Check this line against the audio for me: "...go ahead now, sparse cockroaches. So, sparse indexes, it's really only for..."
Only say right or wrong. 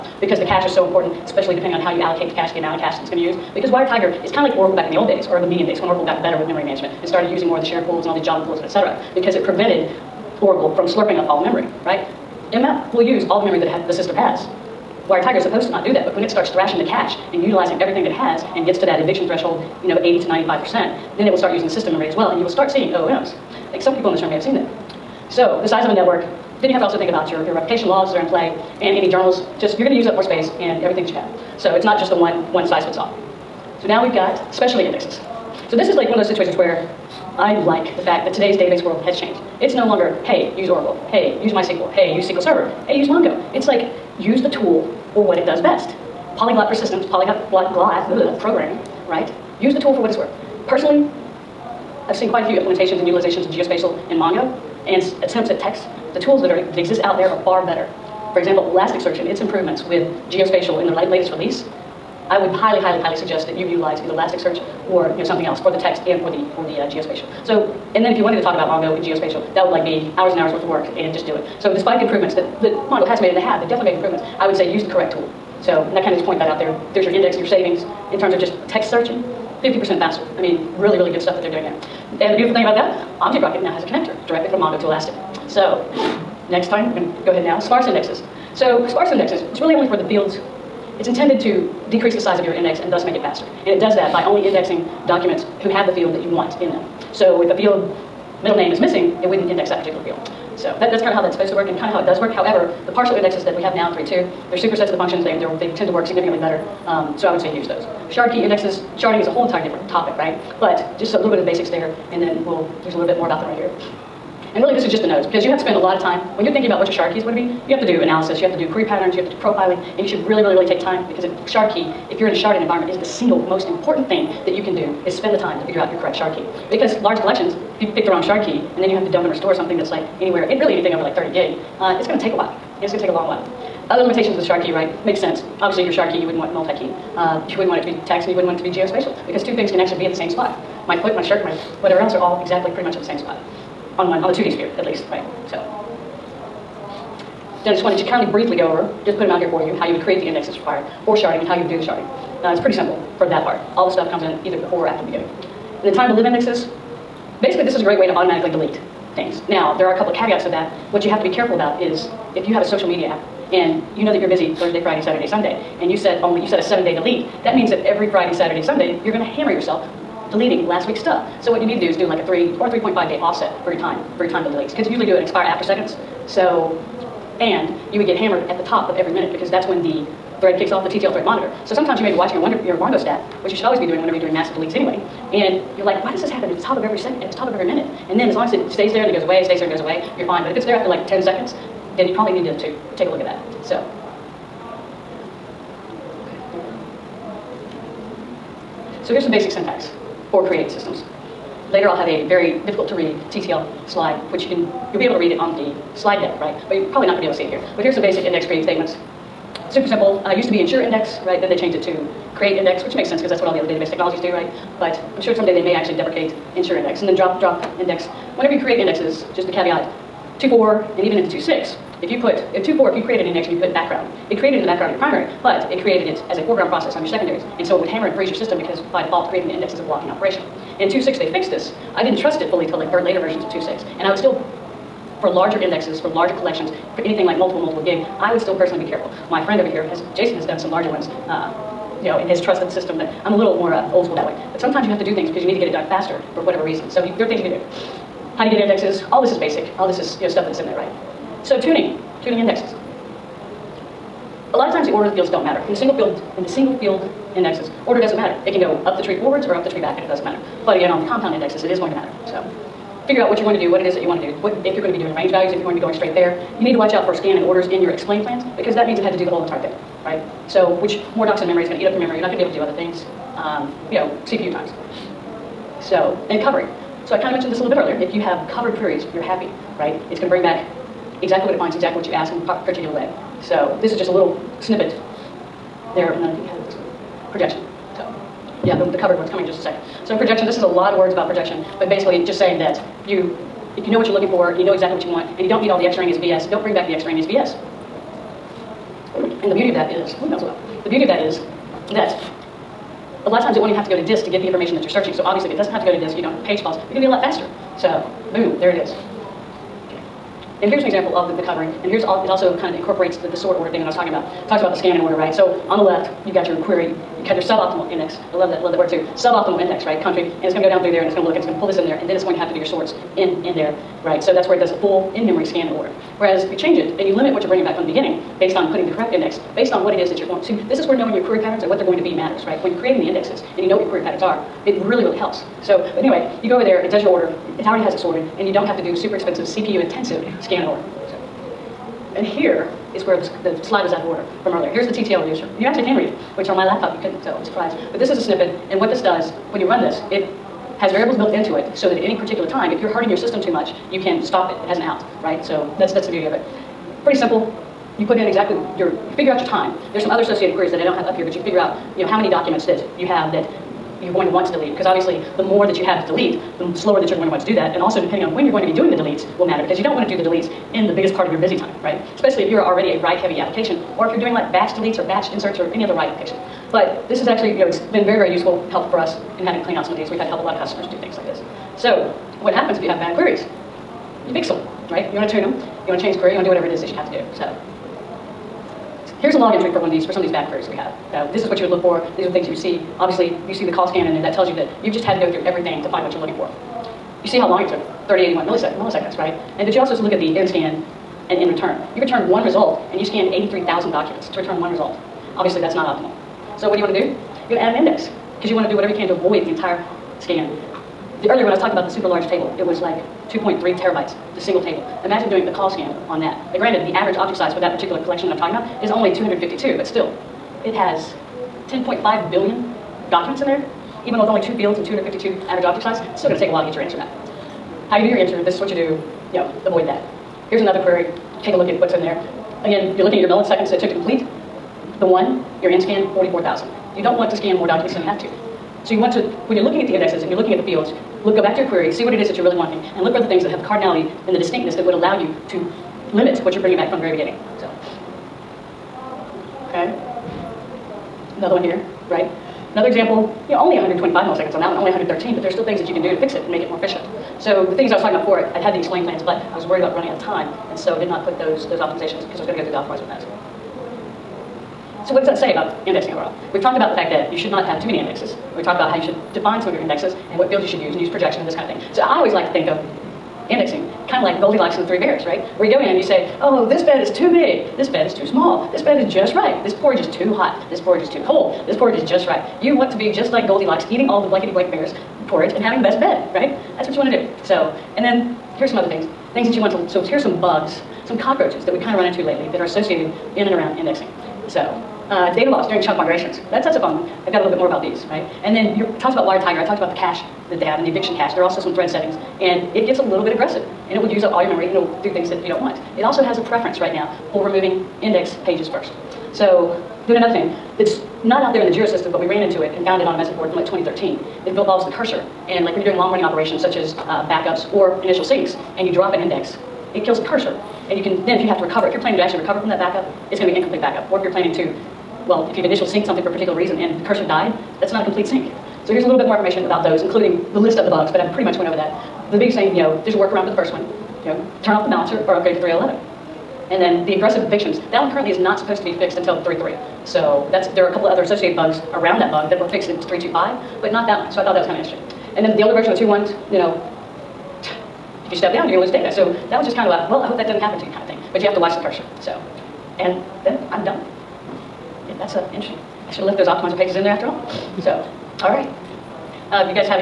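wrong.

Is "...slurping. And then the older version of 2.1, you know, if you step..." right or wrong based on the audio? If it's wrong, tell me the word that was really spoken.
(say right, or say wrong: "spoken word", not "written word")
wrong: "interesting", not "slurping".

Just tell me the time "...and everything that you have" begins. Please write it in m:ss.
0:30.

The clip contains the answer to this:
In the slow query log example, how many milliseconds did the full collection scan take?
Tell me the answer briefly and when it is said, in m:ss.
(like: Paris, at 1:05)
3081, at 6:38.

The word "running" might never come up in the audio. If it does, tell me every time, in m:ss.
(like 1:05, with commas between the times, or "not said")
7:39, 8:36.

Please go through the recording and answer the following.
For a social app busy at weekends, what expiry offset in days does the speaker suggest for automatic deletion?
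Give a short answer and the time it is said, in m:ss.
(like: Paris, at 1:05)
3 or 3.5 days, at 2:52.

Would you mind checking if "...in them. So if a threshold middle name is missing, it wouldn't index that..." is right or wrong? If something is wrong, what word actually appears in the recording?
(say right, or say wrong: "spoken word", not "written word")
wrong: "field", not "threshold".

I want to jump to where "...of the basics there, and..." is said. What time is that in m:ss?
1:51.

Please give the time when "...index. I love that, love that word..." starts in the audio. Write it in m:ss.
5:17.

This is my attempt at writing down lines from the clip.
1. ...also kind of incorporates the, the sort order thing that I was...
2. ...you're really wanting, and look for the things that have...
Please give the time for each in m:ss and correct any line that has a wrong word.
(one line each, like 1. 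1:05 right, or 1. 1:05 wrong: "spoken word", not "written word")
1. 5:12 right
2. 7:22 right.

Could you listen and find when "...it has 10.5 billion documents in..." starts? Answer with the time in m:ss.
7:00.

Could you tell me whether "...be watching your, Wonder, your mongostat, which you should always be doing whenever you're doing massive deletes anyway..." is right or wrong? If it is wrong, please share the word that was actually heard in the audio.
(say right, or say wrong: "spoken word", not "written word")
right.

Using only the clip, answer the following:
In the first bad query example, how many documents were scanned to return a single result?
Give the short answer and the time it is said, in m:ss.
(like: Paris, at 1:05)
83,000, at 6:43.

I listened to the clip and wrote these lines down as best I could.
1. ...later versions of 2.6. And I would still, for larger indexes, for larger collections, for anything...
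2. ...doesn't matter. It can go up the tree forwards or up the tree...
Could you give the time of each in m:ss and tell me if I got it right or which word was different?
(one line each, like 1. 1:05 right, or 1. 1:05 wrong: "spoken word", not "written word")
1. 3:53 right
2. 4:18 right.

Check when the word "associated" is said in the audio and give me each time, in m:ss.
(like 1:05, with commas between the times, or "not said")
6:00, 8:12, 9:01.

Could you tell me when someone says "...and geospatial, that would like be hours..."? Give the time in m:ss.
1:08.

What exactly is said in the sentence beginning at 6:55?
Imagine doing a COLLSCAN on that.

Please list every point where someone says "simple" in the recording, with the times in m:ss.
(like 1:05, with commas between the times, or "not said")
2:32, 3:29, 5:57.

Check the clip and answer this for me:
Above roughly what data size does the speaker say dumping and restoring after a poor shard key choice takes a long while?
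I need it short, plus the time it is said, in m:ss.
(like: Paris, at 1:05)
30 gig, at 2:11.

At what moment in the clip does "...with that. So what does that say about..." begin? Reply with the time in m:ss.
7:43.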